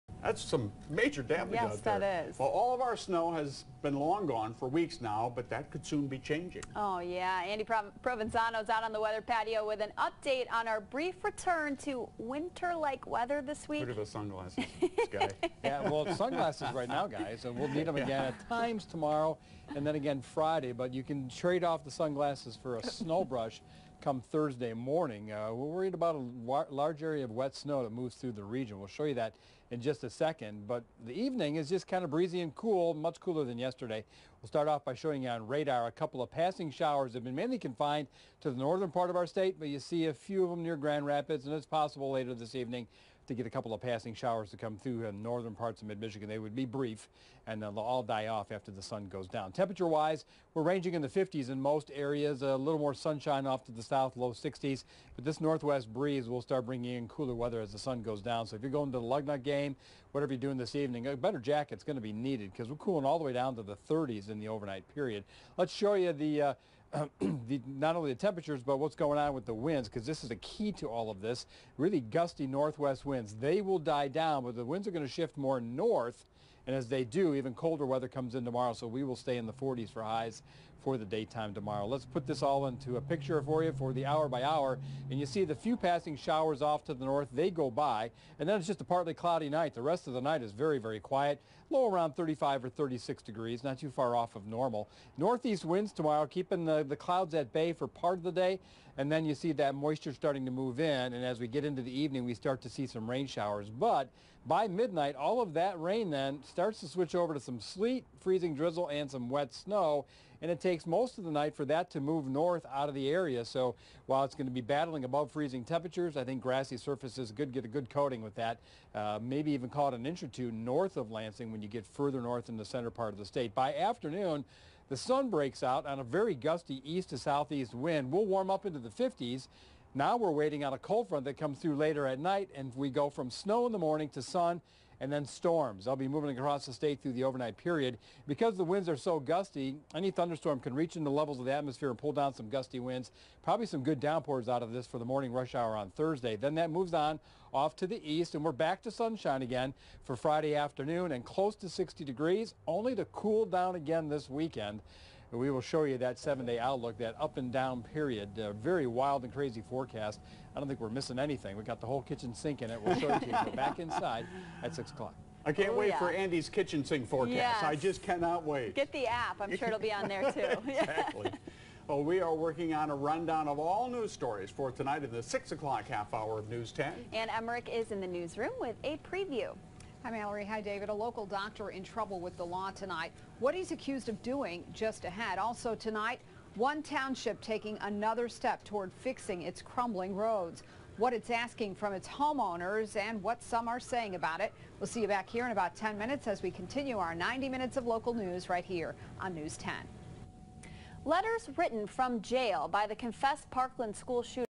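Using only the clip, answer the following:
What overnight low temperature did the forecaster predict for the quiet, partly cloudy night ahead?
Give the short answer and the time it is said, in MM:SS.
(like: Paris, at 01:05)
35 or 36 degrees, at 01:32.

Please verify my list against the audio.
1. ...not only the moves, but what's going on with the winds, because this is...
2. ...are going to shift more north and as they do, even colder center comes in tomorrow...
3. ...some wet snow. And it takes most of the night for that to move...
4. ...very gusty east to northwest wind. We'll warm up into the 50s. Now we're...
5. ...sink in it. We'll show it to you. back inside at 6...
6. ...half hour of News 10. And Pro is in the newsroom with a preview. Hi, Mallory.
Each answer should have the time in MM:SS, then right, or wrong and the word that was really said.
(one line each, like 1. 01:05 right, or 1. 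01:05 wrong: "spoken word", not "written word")
1. 01:07 wrong: "temperatures", not "moves"
2. 01:14 wrong: "weather", not "center"
3. 01:49 right
4. 02:06 wrong: "southeast", not "northwest"
5. 02:42 right
6. 02:55 wrong: "Emmerich", not "Pro".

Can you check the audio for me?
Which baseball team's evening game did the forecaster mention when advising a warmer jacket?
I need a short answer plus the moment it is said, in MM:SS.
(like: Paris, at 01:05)
Lugnut, at 00:59.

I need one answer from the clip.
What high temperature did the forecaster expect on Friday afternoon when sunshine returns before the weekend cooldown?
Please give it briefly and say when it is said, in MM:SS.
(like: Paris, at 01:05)
close to 60 degrees, at 02:31.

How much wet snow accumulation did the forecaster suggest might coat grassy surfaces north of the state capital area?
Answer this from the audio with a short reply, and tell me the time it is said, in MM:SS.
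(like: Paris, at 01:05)
an inch or two, at 01:59.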